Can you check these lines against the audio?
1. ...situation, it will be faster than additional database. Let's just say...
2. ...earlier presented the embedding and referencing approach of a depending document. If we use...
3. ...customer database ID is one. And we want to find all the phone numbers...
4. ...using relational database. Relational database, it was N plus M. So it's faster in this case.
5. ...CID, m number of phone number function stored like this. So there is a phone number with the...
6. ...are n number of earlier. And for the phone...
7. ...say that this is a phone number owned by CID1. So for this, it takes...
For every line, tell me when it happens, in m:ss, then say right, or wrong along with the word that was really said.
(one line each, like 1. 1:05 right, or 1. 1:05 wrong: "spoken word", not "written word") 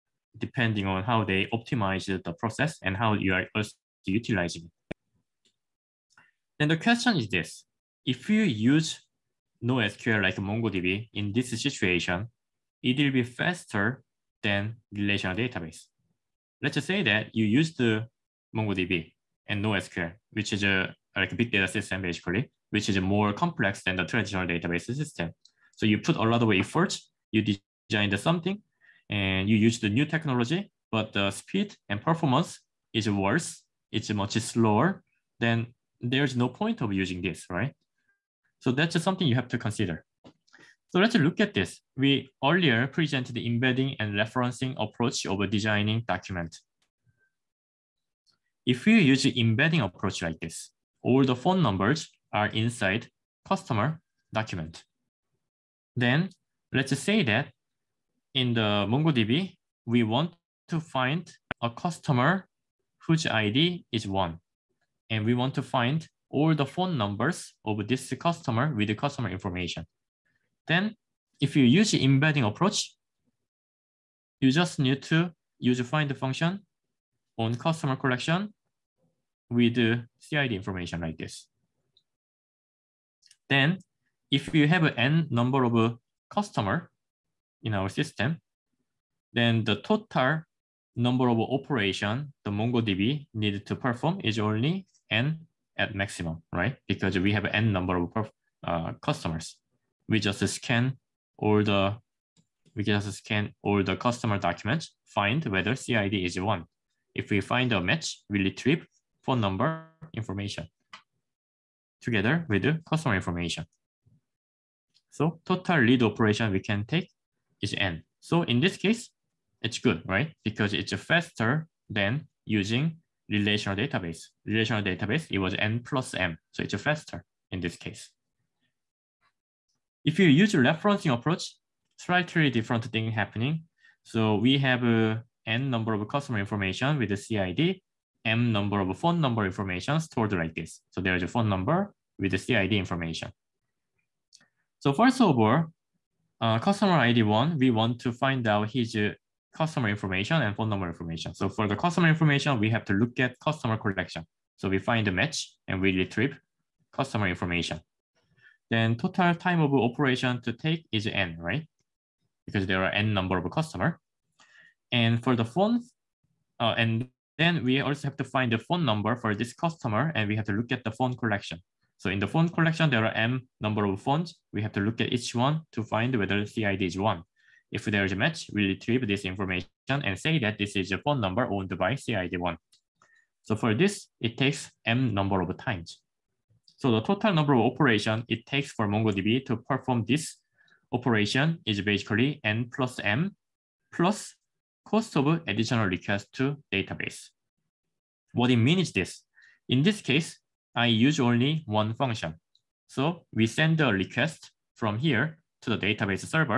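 1. 0:11 wrong: "relational", not "additional"
2. 0:42 wrong: "designing", not "depending"
3. 1:01 wrong: "whose", not "database"
4. 2:02 right
5. 2:17 wrong: "information", not "function"
6. 2:42 wrong: "customer", not "earlier"
7. 3:00 right.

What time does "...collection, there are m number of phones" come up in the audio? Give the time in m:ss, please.
2:52.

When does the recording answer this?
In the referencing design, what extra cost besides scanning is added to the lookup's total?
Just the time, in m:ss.
3:14.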